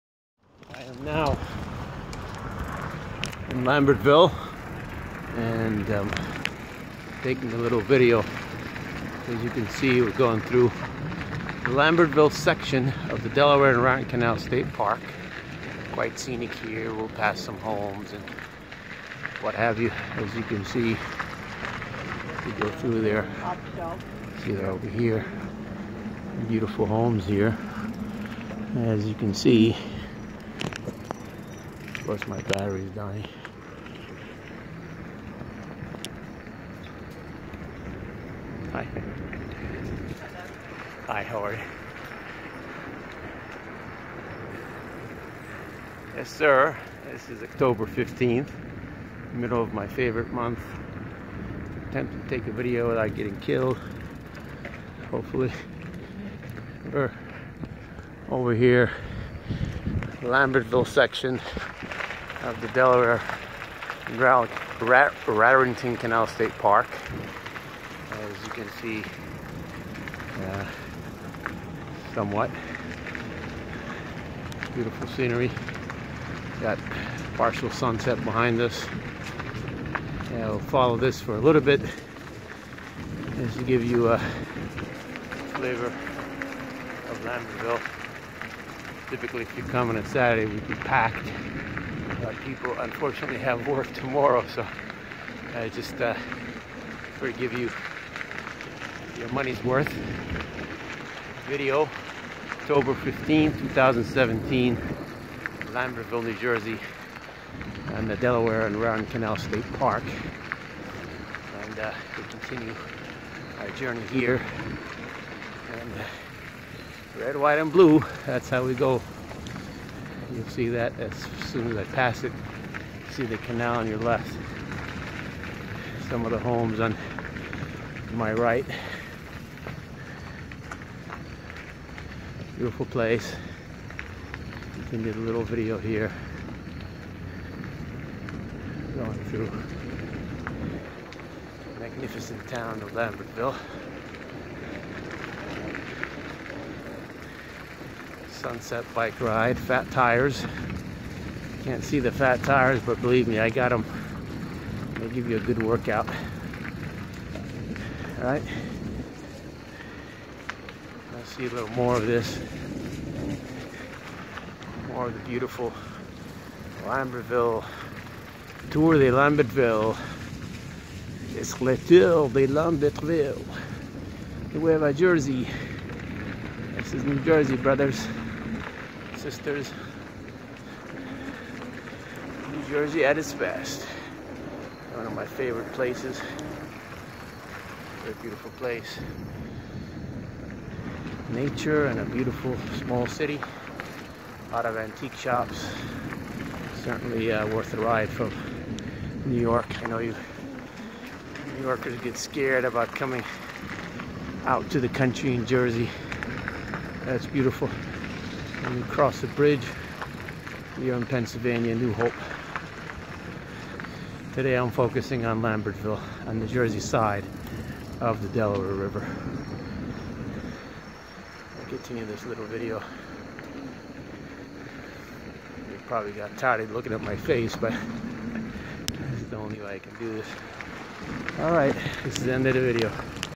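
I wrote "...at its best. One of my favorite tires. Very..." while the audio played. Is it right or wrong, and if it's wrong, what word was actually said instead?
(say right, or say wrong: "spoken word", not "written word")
wrong: "places", not "tires".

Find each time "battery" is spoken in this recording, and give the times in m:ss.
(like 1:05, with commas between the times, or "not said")
0:32.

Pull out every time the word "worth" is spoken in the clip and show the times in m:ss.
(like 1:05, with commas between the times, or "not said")
1:39, 3:17.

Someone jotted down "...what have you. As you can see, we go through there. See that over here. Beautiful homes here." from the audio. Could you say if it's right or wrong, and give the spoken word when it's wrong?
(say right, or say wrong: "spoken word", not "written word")
right.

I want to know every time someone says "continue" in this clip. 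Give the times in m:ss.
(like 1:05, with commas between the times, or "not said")
1:52, 3:41.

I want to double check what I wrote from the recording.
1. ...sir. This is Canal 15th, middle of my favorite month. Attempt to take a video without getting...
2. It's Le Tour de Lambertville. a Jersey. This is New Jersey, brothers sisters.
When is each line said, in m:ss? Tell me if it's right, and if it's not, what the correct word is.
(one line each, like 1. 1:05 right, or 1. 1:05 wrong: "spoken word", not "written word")
1. 0:46 wrong: "October", not "Canal"
2. 2:51 right.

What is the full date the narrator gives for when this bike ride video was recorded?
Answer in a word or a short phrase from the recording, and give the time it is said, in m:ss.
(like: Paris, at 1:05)
October 15, 2017, at 1:42.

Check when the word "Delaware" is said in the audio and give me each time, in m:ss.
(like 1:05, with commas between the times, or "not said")
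0:13, 1:02, 1:48, 3:38.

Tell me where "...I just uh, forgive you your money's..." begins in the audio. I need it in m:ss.
1:35.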